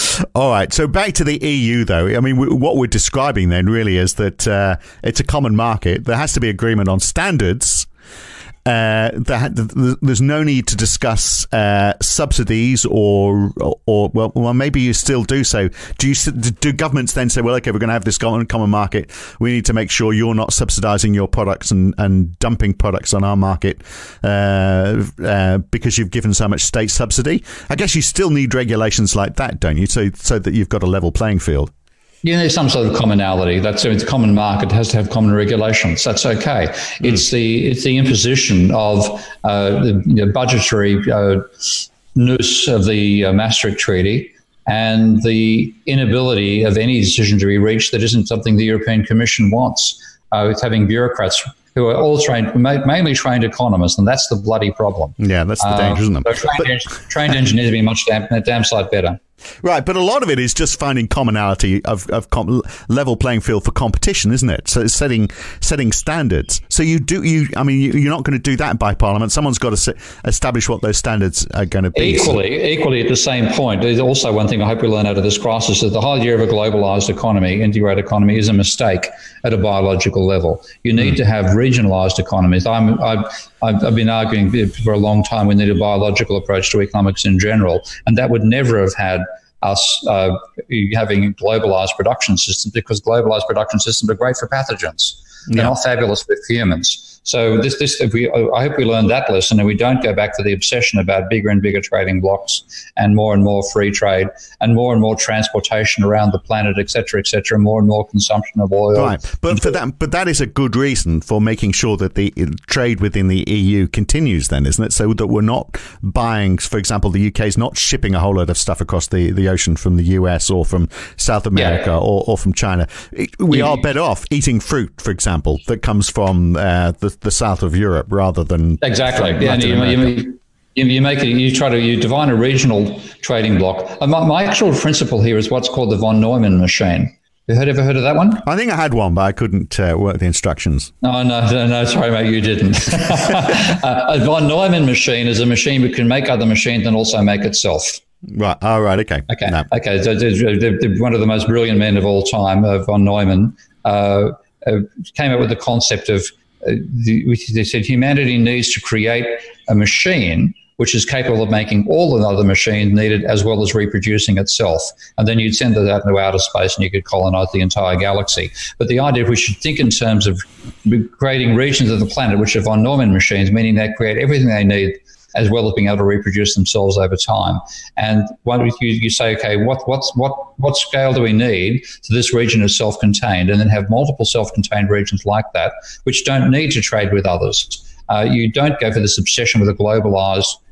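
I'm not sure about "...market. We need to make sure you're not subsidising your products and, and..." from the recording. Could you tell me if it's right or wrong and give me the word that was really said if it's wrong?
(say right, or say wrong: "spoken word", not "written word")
right.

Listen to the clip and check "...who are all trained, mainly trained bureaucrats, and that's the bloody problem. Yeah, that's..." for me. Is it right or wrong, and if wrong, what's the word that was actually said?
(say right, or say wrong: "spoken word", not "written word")
wrong: "economists", not "bureaucrats".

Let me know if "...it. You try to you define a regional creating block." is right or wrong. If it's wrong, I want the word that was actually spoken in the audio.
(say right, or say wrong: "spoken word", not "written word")
wrong: "trading", not "creating".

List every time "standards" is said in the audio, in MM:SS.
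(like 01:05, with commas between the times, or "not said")
00:07, 01:05, 01:10.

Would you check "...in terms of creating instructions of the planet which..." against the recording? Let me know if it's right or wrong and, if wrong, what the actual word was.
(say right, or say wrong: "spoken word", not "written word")
wrong: "regions", not "instructions".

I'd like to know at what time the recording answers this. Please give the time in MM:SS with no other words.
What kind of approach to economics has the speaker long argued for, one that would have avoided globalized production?
01:25.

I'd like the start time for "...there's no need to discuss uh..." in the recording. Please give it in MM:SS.
00:09.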